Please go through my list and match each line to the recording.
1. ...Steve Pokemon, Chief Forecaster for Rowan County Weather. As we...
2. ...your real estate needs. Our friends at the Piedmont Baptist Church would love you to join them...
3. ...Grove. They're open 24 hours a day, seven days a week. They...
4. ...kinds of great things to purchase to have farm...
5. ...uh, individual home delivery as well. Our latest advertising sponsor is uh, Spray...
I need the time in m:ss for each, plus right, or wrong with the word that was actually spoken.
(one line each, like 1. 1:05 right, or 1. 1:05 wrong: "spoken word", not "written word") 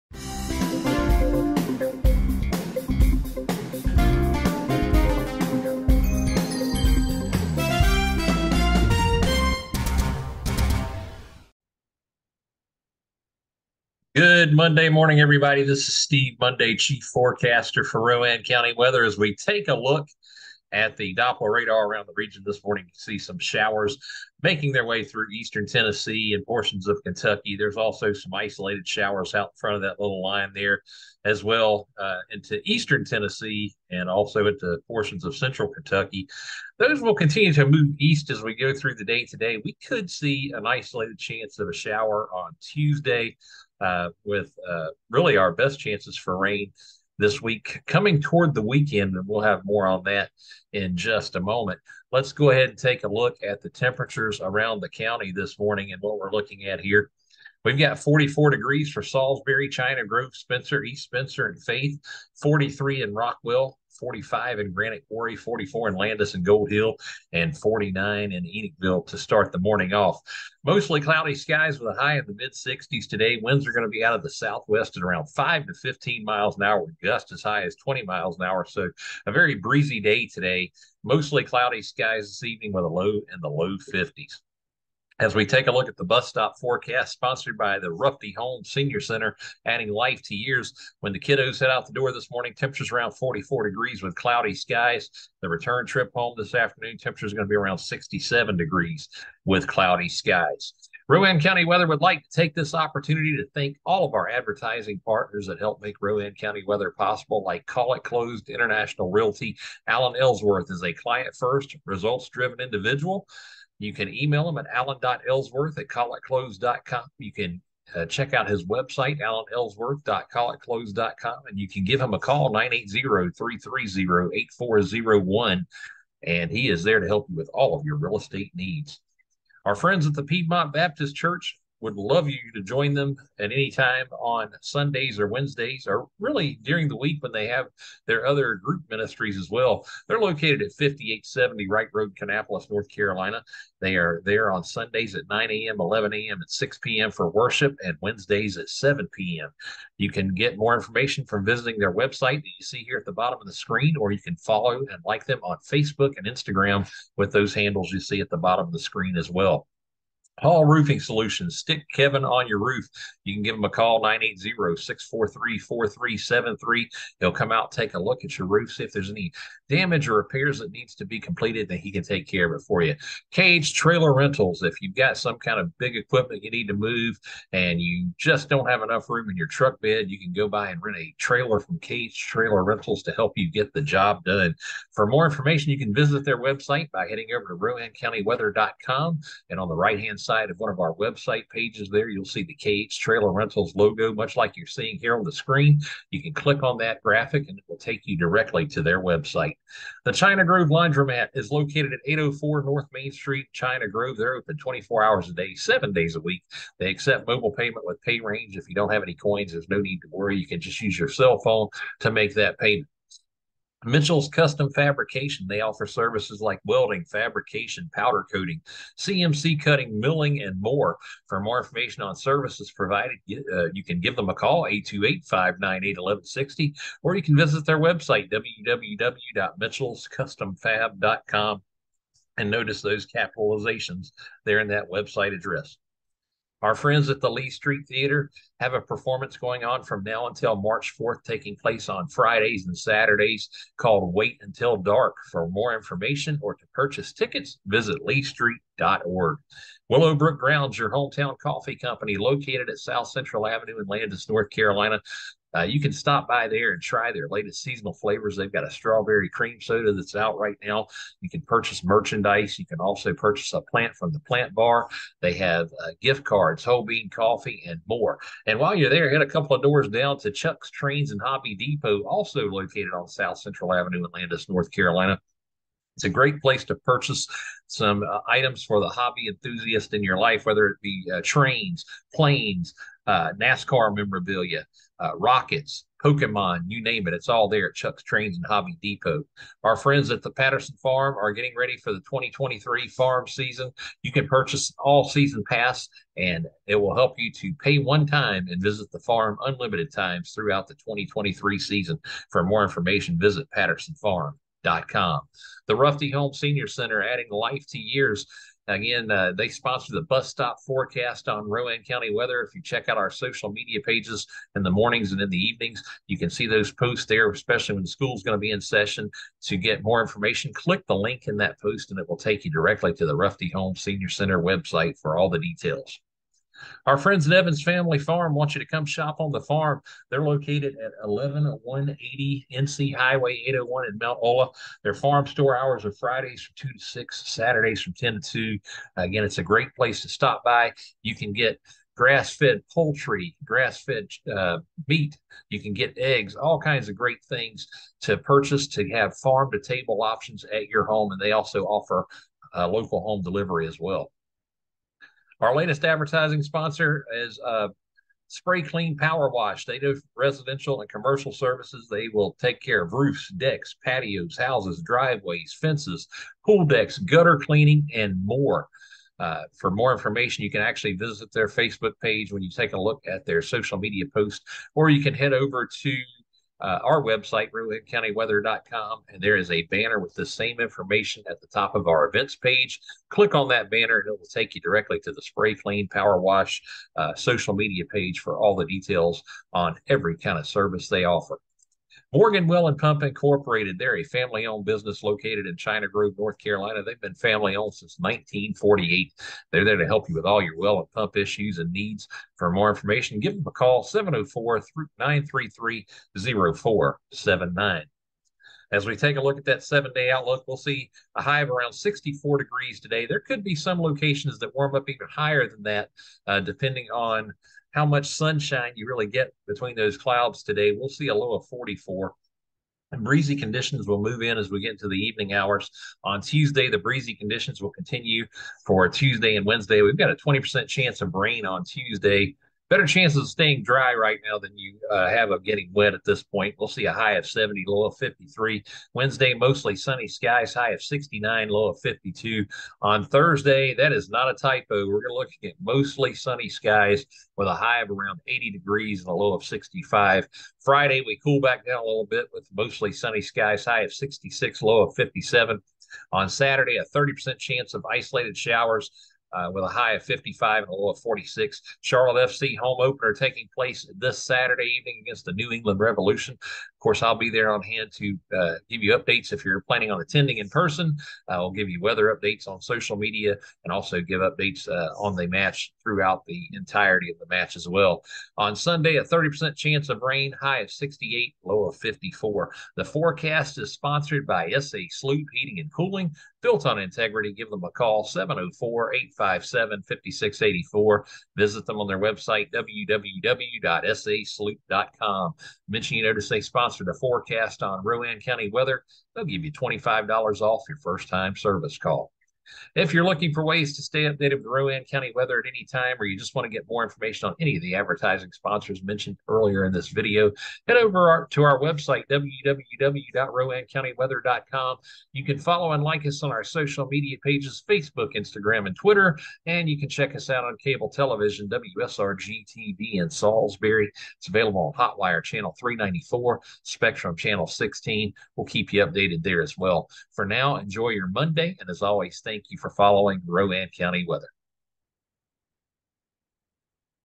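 1. 0:15 wrong: "Monday", not "Pokemon"
2. 2:07 right
3. 3:23 right
4. 5:46 right
5. 5:52 wrong: "local", not "individual".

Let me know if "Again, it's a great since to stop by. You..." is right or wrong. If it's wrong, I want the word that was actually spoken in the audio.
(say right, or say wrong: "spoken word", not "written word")
wrong: "place", not "since".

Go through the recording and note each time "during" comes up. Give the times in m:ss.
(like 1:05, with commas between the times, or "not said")
2:16.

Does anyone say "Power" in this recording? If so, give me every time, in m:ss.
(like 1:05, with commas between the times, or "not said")
5:58, 6:25.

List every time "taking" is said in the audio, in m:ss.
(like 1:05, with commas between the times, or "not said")
4:01, 7:43.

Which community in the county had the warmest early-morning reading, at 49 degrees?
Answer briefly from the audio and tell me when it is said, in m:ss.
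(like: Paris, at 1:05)
Enochville, at 1:08.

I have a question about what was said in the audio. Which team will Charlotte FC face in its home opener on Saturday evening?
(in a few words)
New England Revolution.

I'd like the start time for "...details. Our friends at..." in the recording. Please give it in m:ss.
5:25.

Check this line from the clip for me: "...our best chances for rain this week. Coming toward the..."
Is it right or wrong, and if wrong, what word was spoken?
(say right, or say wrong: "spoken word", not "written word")
right.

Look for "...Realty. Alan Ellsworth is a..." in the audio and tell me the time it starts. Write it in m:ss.
1:49.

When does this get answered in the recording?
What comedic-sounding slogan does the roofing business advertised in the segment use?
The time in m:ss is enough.
2:41.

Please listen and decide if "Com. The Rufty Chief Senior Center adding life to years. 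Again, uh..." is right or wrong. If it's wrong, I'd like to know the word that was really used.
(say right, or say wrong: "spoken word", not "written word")
wrong: "Holmes", not "Chief".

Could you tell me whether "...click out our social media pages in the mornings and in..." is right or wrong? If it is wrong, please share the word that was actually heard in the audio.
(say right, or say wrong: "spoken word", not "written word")
wrong: "check", not "click".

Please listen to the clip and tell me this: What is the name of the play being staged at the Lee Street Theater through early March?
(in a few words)
Wait Until Dark.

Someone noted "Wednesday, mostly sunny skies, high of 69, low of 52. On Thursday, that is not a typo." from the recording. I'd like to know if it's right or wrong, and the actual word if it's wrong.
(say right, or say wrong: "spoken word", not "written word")
right.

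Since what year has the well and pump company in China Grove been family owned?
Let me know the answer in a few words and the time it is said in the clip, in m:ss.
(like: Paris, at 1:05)
1948, at 6:37.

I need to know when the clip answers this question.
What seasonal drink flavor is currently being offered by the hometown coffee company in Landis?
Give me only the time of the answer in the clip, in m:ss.
4:18.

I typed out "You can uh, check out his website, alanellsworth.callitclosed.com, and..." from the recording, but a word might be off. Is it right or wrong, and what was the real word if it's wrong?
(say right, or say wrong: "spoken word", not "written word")
right.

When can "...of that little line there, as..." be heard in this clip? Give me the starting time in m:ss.
0:29.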